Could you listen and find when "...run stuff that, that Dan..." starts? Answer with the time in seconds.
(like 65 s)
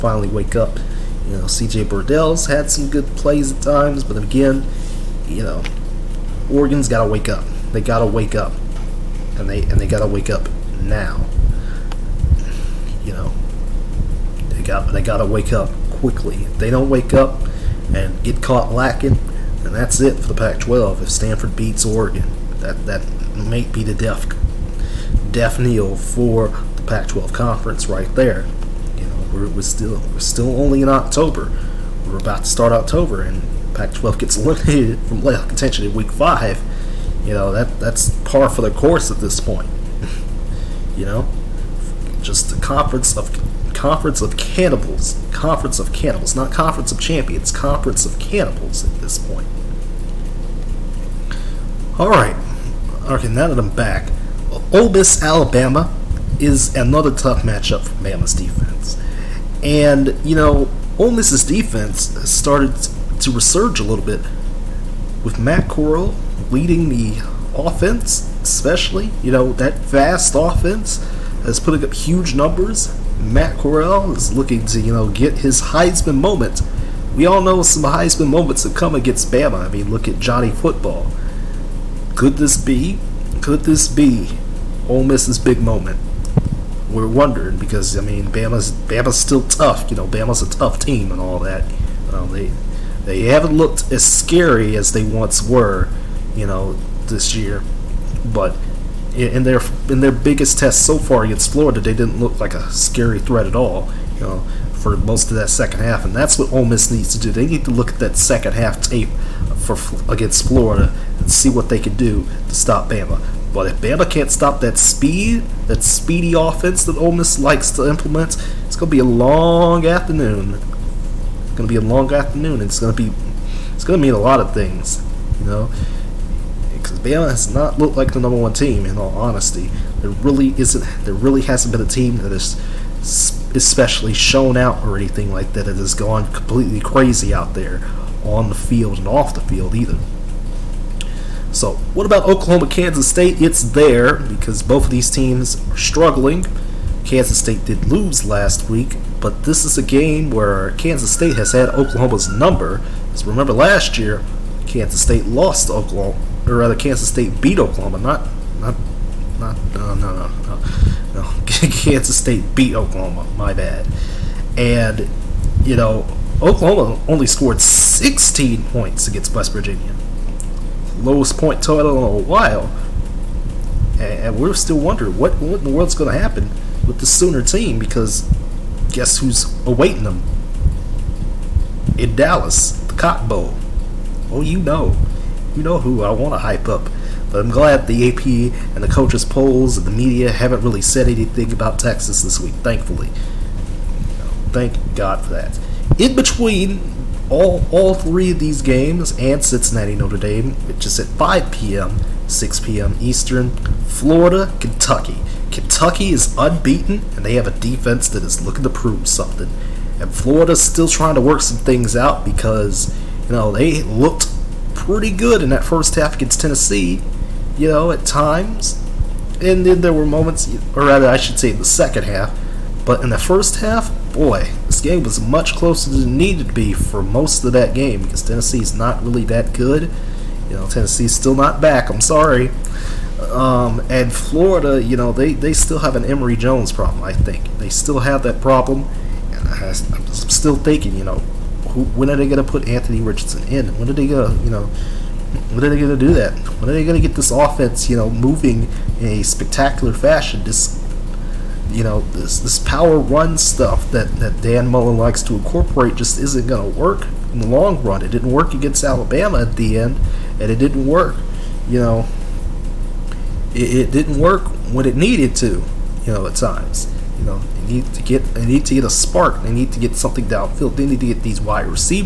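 252 s.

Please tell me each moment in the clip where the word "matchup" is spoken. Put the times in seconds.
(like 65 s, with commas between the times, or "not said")
57 s.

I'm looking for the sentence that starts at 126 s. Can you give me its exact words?
Because Bama has not looked like the number one team, in all honesty.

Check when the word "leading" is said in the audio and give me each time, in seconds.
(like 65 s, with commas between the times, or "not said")
66 s.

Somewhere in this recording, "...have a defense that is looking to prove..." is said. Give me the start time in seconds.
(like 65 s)
207 s.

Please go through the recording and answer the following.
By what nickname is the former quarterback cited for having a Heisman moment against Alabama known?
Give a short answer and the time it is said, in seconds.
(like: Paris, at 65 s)
Johnny Football, at 80 s.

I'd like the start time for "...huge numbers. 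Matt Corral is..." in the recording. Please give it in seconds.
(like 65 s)
71 s.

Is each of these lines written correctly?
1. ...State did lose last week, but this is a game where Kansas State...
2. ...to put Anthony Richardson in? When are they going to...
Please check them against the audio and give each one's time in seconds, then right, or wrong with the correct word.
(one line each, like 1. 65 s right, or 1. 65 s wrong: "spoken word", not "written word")
1. 147 s right
2. 242 s right.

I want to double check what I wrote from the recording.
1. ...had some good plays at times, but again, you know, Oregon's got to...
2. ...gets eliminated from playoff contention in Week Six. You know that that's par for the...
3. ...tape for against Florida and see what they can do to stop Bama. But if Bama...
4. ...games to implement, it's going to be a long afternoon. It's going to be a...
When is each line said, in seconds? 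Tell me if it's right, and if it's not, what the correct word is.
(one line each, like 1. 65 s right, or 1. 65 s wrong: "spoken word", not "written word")
1. 2 s right
2. 34 s wrong: "Five", not "Six"
3. 108 s right
4. 117 s wrong: "likes", not "games".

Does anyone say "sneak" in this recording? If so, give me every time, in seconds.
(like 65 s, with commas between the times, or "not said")
not said.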